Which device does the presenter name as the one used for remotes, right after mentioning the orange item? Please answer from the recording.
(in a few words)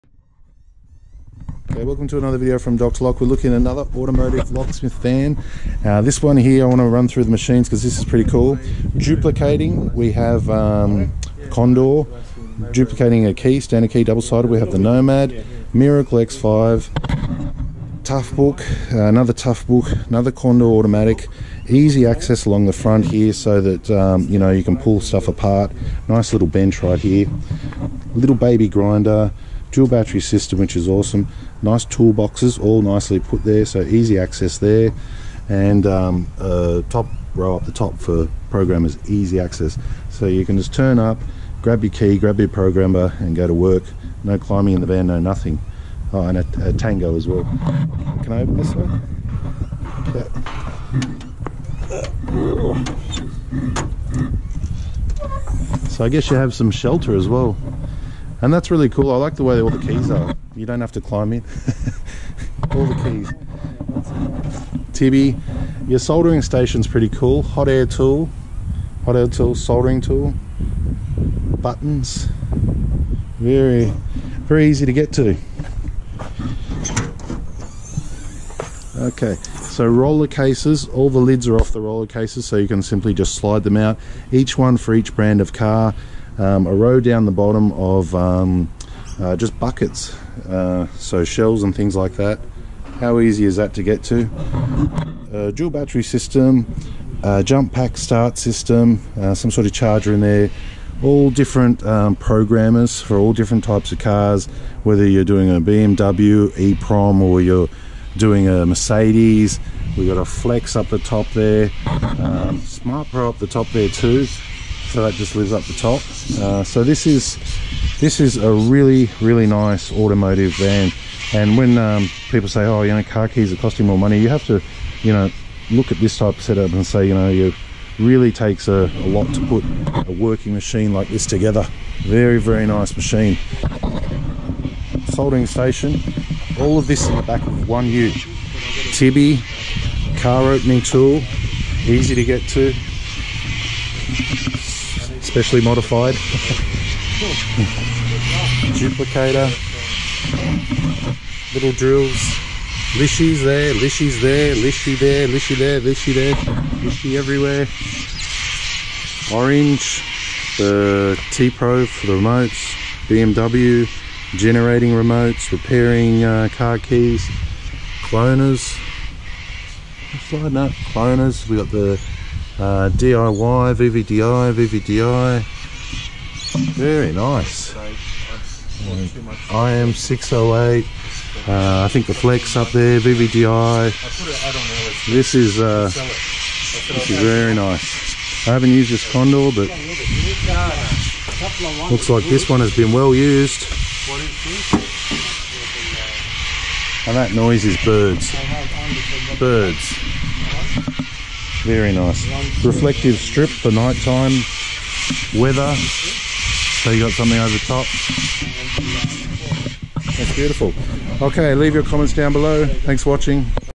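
T-Pro.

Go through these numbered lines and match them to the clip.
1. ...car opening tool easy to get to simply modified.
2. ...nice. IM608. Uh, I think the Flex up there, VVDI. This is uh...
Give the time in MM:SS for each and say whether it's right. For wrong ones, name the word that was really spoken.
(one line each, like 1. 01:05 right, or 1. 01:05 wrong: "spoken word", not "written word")
1. 02:20 wrong: "specially", not "simply"
2. 02:57 right.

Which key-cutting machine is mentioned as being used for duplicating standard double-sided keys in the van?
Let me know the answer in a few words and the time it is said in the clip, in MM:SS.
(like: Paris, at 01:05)
Nomad, at 00:14.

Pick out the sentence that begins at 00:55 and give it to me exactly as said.
So I guess you have some shelter as well and that's really cool.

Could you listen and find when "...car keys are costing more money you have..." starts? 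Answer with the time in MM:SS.
02:03.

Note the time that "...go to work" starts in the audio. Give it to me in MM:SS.
00:43.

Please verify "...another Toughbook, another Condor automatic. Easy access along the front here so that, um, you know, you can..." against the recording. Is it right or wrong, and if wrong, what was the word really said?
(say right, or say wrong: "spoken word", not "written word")
right.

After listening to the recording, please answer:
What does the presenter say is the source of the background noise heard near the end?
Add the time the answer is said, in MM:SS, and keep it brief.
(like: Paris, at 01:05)
Birds, at 03:17.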